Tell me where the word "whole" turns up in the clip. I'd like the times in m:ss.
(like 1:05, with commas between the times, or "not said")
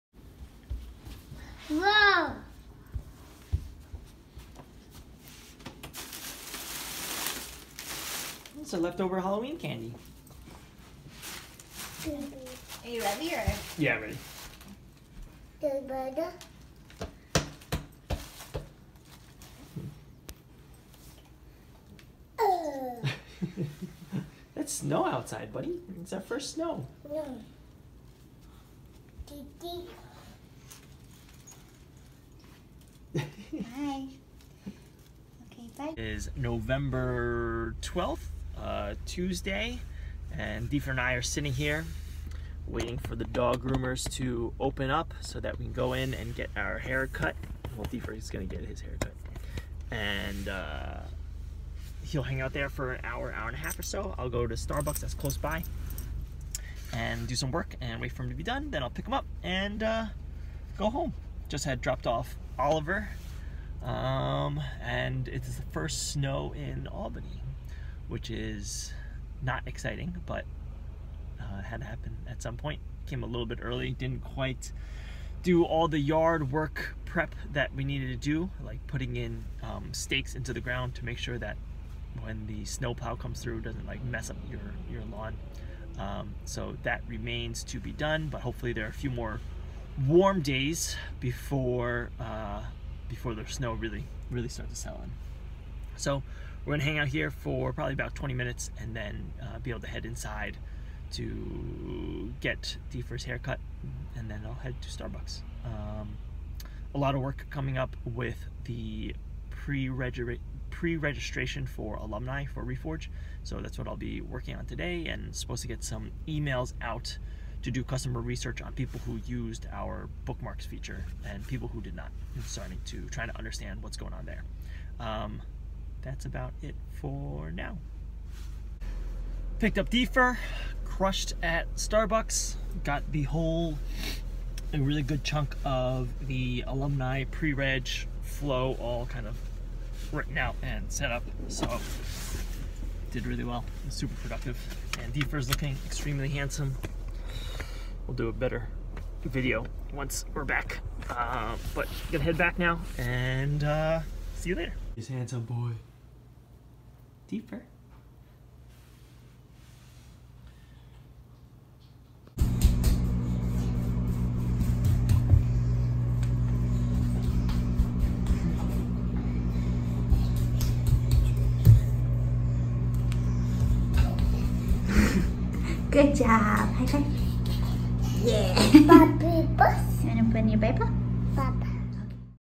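2:13.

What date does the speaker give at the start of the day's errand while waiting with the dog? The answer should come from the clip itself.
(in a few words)
November 12.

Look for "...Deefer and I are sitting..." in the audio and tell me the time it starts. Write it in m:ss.
0:40.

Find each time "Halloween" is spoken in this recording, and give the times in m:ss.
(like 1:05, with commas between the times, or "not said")
0:09.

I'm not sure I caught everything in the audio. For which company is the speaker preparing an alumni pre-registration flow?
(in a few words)
Reforge.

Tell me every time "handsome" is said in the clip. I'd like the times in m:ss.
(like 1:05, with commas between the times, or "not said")
2:26, 2:35.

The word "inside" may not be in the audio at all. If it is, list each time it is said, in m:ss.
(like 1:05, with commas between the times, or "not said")
1:40.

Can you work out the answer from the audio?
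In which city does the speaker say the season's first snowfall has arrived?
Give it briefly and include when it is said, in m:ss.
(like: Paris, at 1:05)
Albany, at 1:06.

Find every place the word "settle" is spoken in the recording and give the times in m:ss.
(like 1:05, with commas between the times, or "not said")
1:34.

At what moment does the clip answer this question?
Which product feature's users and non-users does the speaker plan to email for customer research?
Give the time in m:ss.
2:00.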